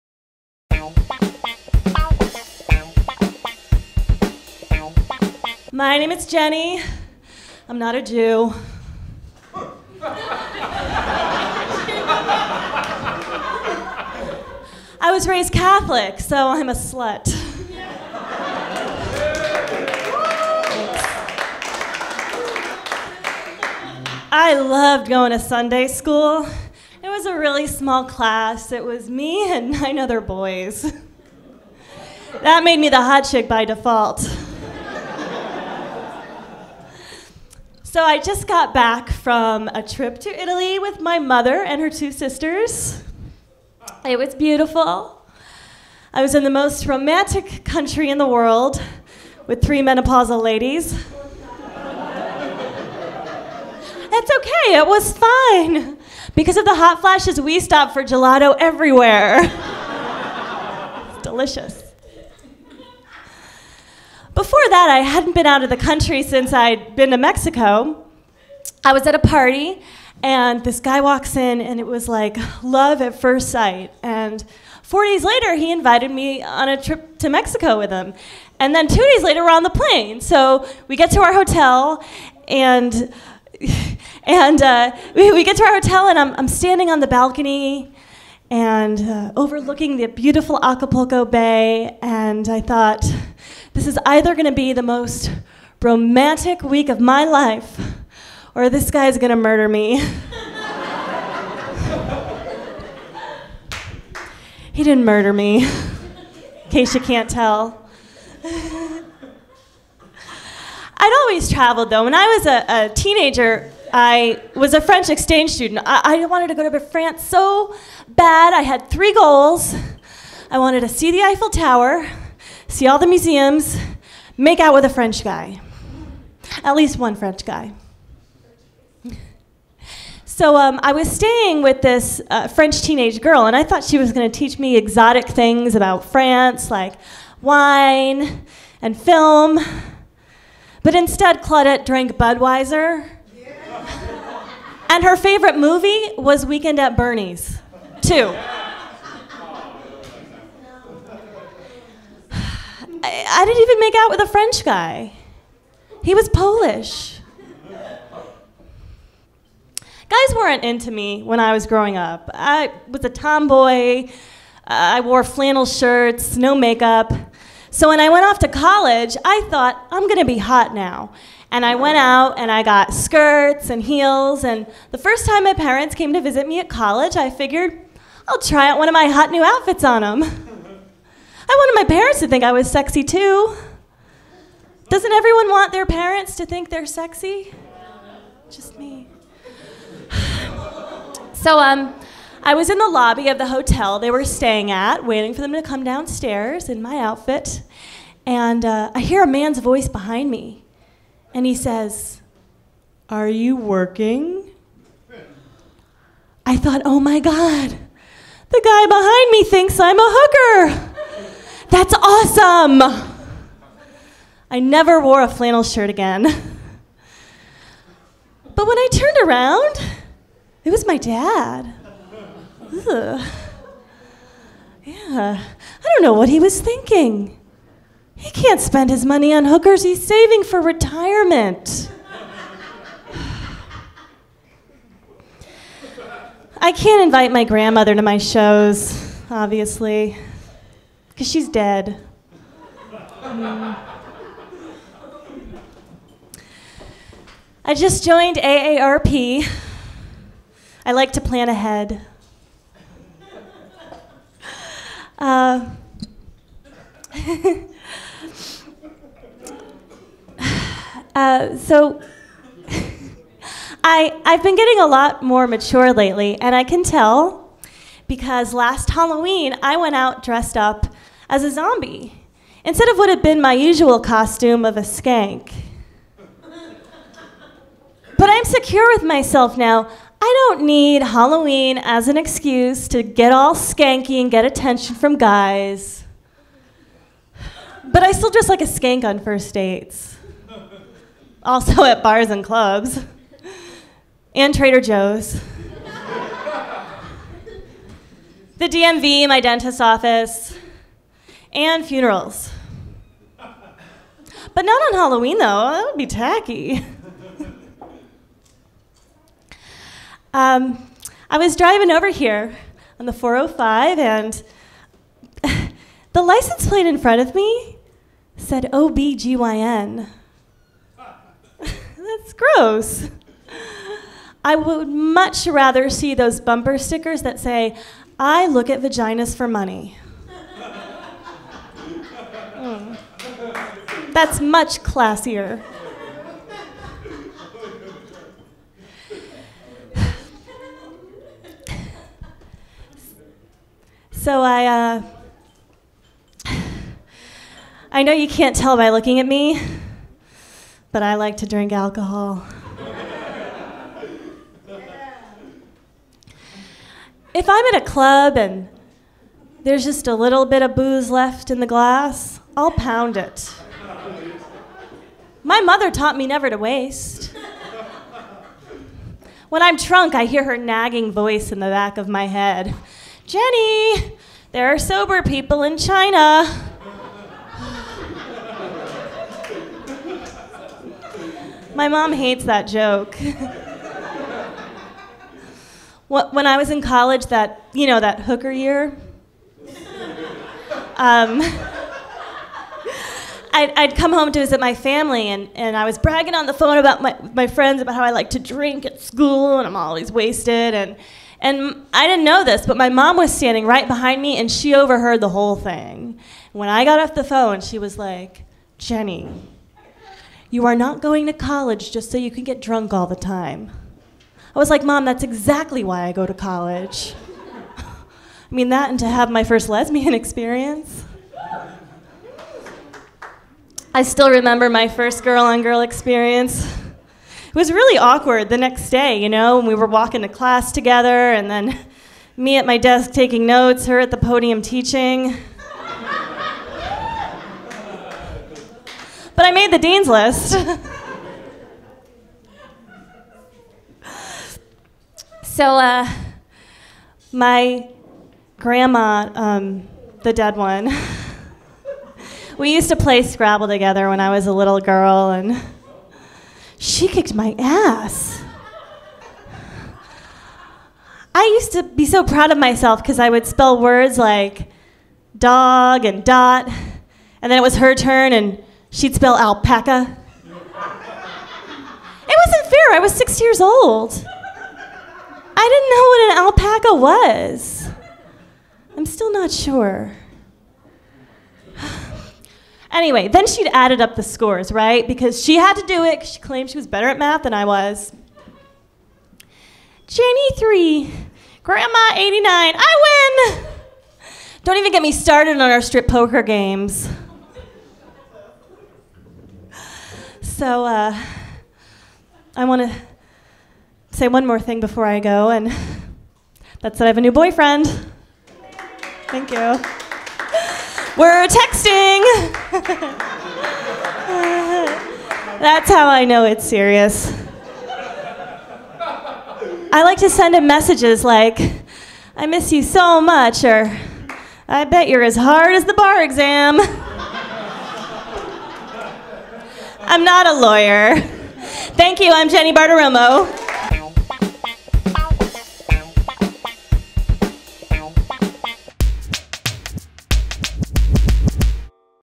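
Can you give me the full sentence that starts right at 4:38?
but I'm secure with myself now.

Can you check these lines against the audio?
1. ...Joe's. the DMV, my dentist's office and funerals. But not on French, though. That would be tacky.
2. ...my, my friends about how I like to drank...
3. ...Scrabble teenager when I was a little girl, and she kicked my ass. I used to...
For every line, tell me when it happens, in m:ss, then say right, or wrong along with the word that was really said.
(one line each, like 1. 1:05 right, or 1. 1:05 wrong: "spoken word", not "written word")
1. 4:54 wrong: "Halloween", not "French"
2. 6:37 wrong: "drink", not "drank"
3. 7:33 wrong: "together", not "teenager".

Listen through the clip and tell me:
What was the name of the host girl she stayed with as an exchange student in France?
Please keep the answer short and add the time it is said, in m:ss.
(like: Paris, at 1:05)
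Claudette, at 2:21.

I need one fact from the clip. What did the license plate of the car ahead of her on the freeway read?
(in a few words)
OBGYN.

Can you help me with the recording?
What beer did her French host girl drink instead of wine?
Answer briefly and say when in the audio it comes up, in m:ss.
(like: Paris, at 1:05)
Budweiser, at 2:22.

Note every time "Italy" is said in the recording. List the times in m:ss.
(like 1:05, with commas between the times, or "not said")
0:40.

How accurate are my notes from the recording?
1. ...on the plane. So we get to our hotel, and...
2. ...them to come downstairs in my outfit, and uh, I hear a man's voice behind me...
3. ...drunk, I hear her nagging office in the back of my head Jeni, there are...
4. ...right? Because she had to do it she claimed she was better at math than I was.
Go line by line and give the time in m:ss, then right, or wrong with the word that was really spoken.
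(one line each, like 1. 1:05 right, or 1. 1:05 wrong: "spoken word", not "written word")
1. 1:19 right
2. 3:15 right
3. 6:09 wrong: "voice", not "office"
4. 8:04 right.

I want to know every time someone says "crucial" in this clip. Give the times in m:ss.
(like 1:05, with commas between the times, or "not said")
not said.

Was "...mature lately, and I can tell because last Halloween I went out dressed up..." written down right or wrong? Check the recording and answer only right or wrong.
right.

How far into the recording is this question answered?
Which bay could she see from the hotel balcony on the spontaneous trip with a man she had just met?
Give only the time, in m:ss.
1:30.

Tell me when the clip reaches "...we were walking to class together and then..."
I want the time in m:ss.
7:09.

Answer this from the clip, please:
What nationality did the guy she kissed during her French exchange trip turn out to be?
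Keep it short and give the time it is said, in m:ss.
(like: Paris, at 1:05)
Polish, at 2:36.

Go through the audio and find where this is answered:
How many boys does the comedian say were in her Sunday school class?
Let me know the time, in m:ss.
0:29.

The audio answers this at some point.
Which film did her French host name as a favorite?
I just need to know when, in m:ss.
2:26.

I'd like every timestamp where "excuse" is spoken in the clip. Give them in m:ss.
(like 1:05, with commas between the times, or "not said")
4:42.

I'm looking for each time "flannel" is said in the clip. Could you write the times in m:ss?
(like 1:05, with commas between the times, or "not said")
2:45, 3:35.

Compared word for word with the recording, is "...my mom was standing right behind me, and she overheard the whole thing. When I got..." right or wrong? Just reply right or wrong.
right.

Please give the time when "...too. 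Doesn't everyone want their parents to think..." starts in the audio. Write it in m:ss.
3:03.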